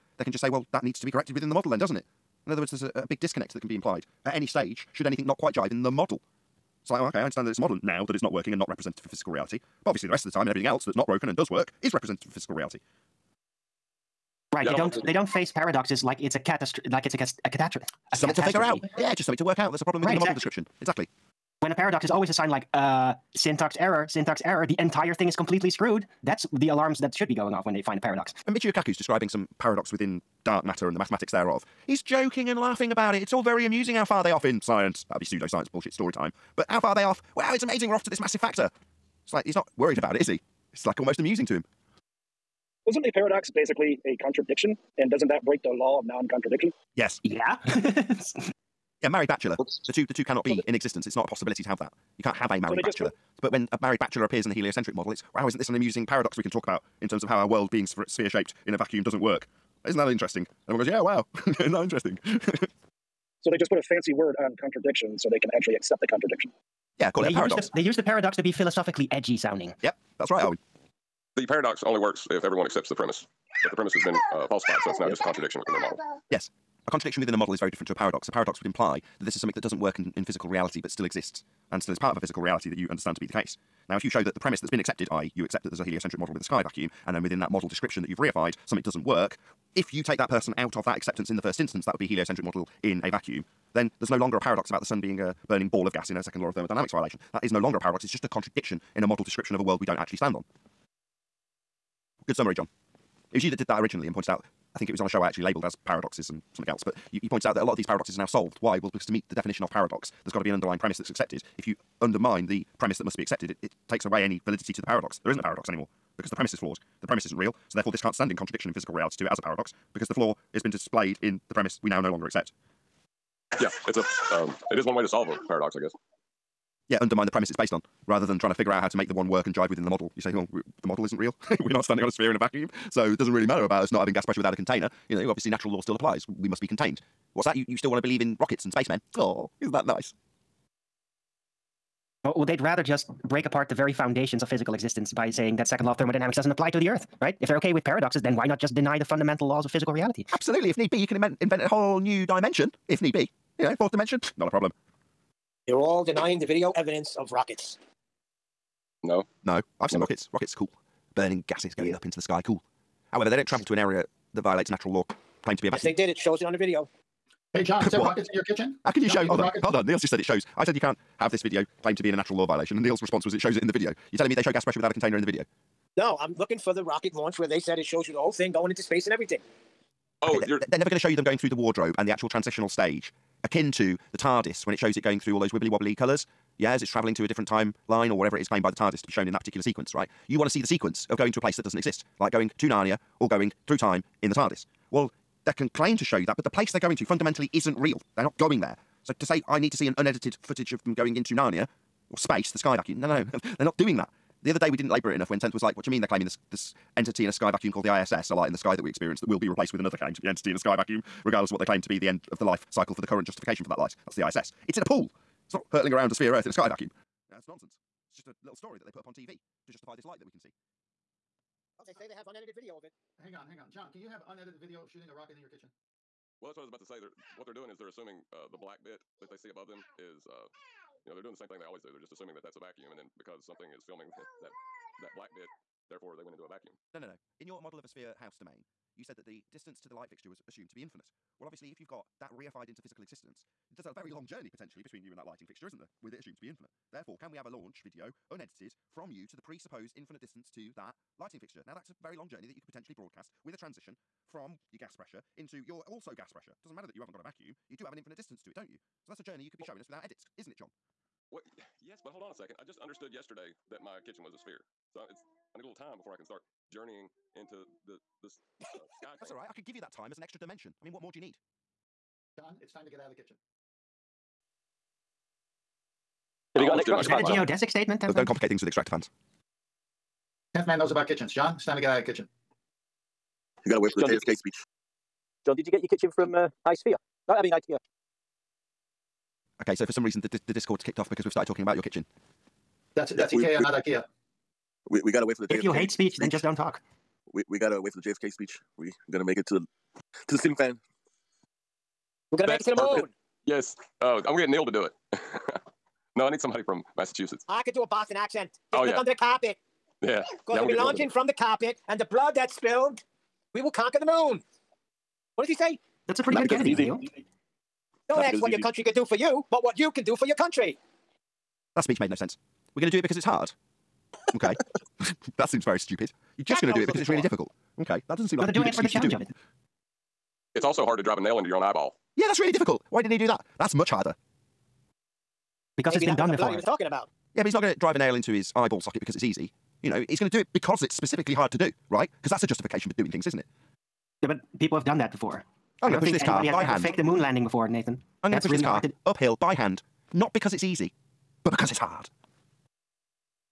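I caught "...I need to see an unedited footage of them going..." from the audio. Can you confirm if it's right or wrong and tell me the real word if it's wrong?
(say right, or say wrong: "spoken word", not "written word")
right.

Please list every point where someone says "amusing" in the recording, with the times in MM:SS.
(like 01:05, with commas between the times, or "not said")
00:33, 00:41, 00:55.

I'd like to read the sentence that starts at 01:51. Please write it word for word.
If you undermine the premise that must be accepted, it, it takes away any validity to the paradox.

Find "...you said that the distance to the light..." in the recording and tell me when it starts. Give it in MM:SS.
03:58.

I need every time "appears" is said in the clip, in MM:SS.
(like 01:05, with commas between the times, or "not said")
00:54.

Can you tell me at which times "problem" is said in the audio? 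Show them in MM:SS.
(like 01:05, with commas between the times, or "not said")
00:19, 02:34.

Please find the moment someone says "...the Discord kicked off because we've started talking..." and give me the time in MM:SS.
04:50.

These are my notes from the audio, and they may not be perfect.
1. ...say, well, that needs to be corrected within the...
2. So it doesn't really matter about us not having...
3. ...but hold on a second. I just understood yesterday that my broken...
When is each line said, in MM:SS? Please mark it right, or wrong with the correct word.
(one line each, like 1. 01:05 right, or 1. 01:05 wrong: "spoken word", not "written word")
1. 00:00 right
2. 02:12 right
3. 04:22 wrong: "kitchen", not "broken".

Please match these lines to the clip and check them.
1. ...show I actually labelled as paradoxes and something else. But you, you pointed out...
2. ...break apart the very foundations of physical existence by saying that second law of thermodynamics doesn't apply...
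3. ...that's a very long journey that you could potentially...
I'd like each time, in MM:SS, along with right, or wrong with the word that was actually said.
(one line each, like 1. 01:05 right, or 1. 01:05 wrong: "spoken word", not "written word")
1. 01:45 right
2. 02:23 right
3. 04:11 right.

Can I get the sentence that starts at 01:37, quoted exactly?
That is no longer a paradox, it's just a contradiction in a model description of a world we don't actually stand on.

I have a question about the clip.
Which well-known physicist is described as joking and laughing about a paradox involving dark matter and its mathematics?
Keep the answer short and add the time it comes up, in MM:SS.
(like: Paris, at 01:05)
Michio Kaku, at 00:28.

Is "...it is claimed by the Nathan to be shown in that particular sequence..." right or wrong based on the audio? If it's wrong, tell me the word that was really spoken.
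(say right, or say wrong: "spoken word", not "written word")
wrong: "TARDIS", not "Nathan".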